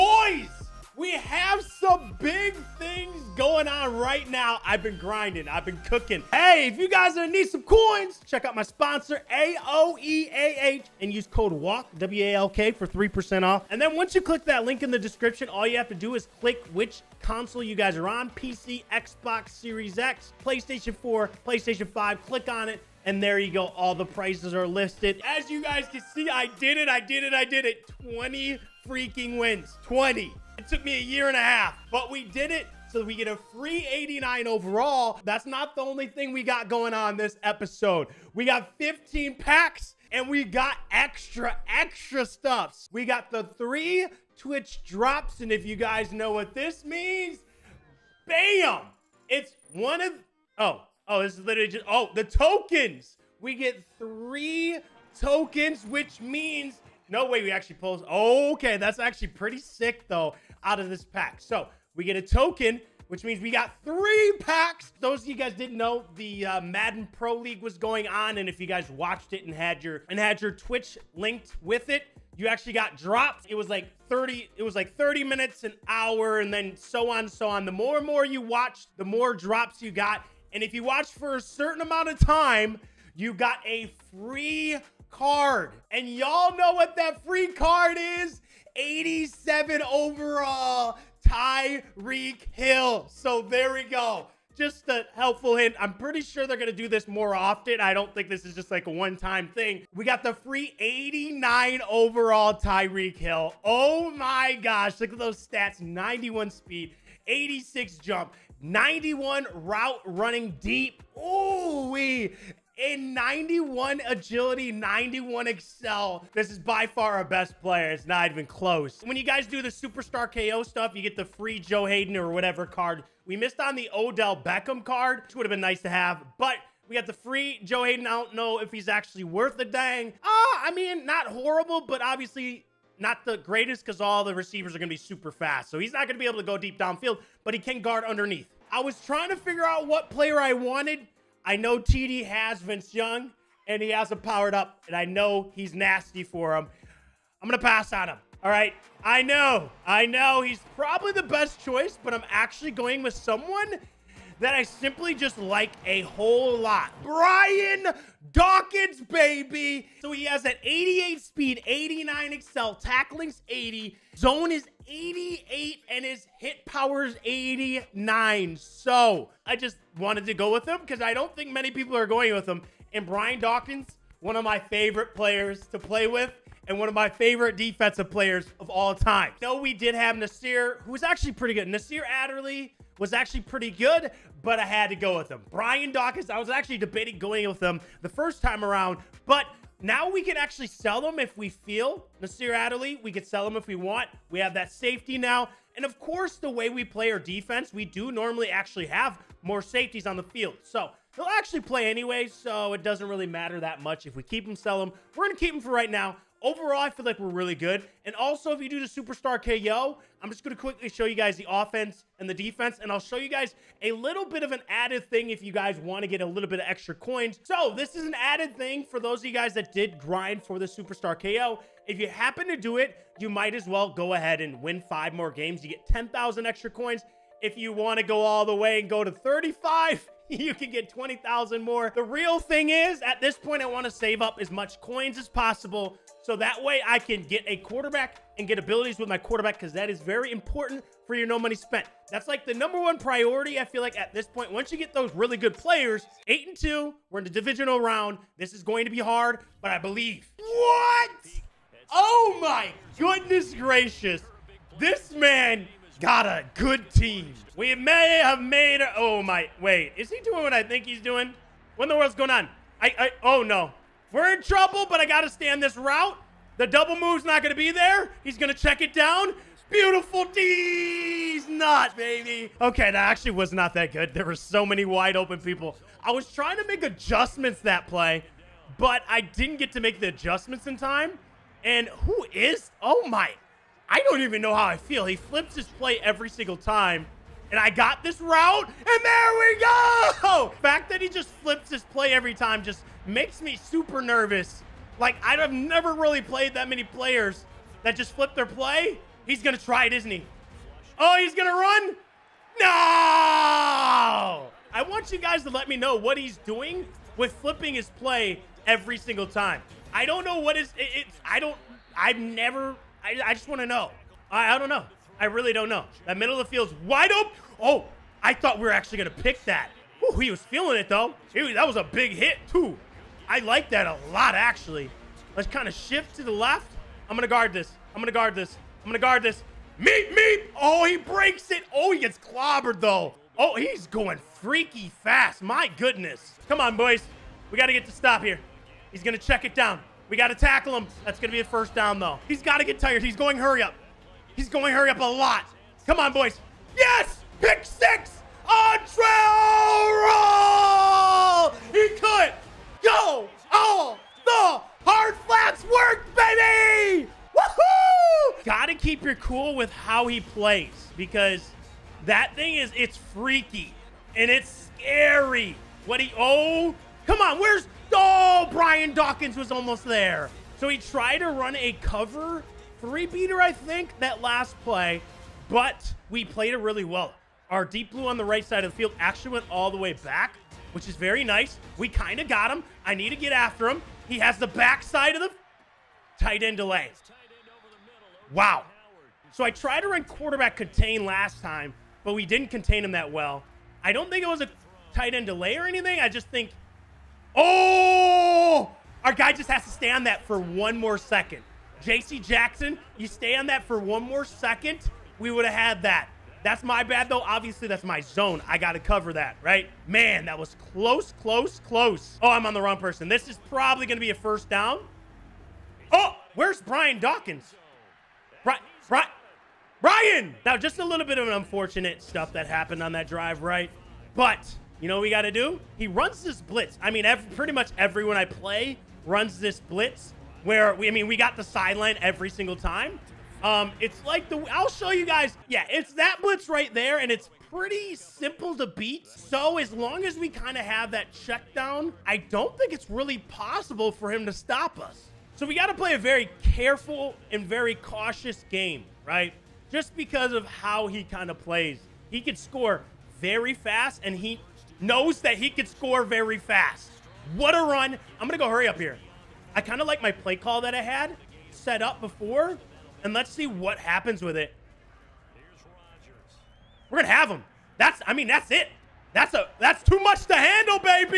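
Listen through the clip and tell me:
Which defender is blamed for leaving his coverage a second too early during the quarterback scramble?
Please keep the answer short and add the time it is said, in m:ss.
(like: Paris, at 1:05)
JC Jackson, at 6:41.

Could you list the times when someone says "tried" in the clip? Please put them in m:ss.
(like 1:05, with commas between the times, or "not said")
6:10, 6:29.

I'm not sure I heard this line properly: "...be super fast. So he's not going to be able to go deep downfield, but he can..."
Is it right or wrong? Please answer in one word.
right.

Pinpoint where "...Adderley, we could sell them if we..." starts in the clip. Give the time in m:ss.
3:12.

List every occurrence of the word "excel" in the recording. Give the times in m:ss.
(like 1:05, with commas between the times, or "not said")
1:55, 2:42.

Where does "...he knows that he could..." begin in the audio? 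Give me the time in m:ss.
7:34.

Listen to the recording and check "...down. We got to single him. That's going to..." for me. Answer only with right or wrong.
wrong.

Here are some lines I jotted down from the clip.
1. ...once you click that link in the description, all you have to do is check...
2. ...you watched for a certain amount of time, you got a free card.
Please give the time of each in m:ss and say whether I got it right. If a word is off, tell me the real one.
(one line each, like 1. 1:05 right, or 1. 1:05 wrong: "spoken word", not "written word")
1. 0:13 wrong: "click", not "check"
2. 1:20 right.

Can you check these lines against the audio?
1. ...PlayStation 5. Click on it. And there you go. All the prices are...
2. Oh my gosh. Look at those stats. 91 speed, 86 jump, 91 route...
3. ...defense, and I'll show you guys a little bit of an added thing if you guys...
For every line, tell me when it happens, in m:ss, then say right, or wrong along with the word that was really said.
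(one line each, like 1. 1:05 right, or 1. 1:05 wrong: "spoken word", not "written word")
1. 0:21 right
2. 1:43 right
3. 3:32 right.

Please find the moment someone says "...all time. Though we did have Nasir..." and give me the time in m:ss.
2:58.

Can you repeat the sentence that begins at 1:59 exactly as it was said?
When you guys do the superstar KO stuff, you get the free Joe Haden or whatever card.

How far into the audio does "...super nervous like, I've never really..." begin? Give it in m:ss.
4:53.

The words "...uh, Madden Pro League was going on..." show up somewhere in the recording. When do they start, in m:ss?
1:06.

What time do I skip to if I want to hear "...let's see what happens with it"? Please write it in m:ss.
7:43.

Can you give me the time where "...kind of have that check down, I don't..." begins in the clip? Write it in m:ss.
7:20.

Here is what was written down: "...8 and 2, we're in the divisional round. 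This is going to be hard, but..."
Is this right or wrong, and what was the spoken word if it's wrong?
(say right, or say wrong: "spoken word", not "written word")
right.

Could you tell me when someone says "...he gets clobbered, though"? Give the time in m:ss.
5:31.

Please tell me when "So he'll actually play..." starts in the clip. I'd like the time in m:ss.
3:20.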